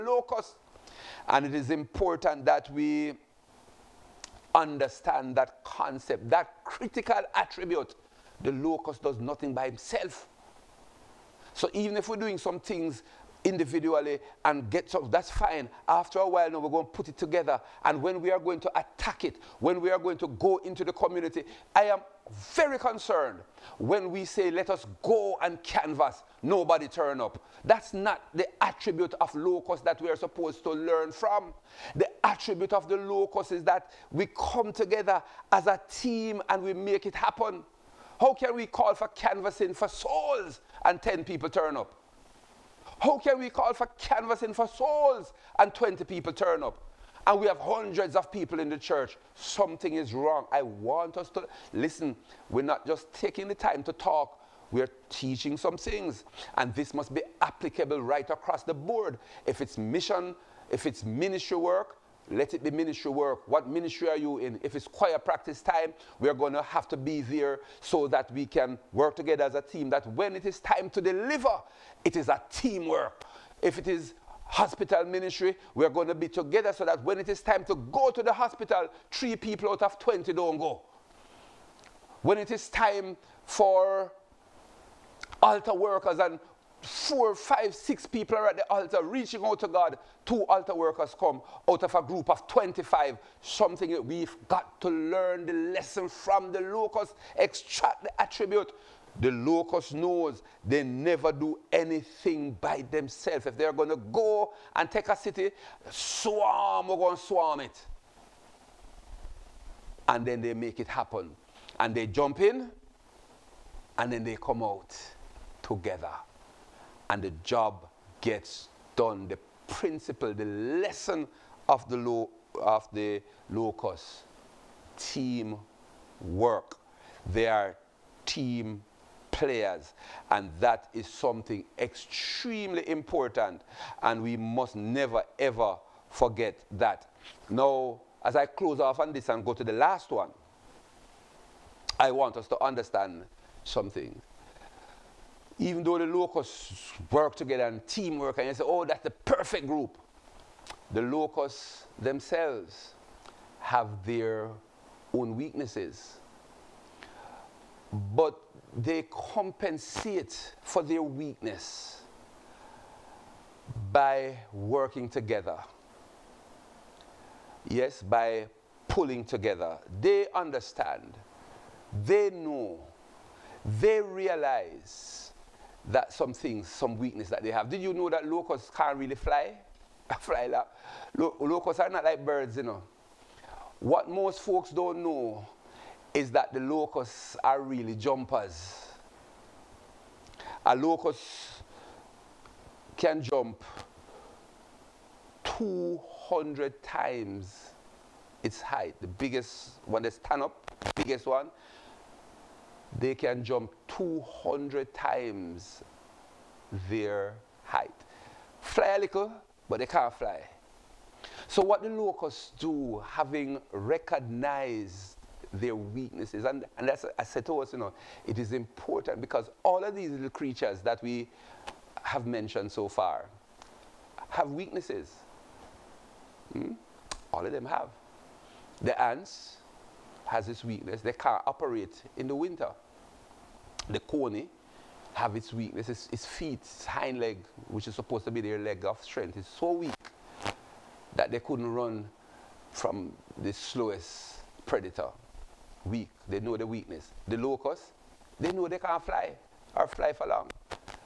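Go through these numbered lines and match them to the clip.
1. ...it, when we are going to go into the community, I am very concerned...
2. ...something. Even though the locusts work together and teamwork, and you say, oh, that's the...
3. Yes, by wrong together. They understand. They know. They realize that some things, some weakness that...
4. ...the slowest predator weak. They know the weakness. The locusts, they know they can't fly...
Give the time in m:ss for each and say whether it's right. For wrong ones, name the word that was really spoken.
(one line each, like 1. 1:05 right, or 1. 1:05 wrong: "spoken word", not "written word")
1. 0:19 right
2. 2:23 right
3. 2:47 wrong: "pulling", not "wrong"
4. 4:03 right.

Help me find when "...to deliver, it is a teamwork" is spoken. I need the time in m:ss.
1:10.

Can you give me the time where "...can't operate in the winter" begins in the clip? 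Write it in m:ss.
3:51.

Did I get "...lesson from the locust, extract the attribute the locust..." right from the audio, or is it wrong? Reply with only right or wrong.
right.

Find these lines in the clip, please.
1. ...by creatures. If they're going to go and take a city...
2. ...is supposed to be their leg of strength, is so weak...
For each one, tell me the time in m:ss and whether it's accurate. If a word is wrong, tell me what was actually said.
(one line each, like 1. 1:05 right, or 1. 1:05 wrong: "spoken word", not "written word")
1. 1:42 wrong: "themselves", not "creatures"
2. 3:57 right.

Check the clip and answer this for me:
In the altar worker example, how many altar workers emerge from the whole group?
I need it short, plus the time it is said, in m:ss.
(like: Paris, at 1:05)
2, at 1:30.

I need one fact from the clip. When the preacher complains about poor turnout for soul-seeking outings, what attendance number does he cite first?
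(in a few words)
10.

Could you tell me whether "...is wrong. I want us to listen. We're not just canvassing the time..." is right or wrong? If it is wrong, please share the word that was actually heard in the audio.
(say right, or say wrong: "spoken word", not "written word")
wrong: "taking", not "canvassing".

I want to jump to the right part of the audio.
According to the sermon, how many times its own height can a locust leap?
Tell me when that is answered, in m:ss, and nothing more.
3:15.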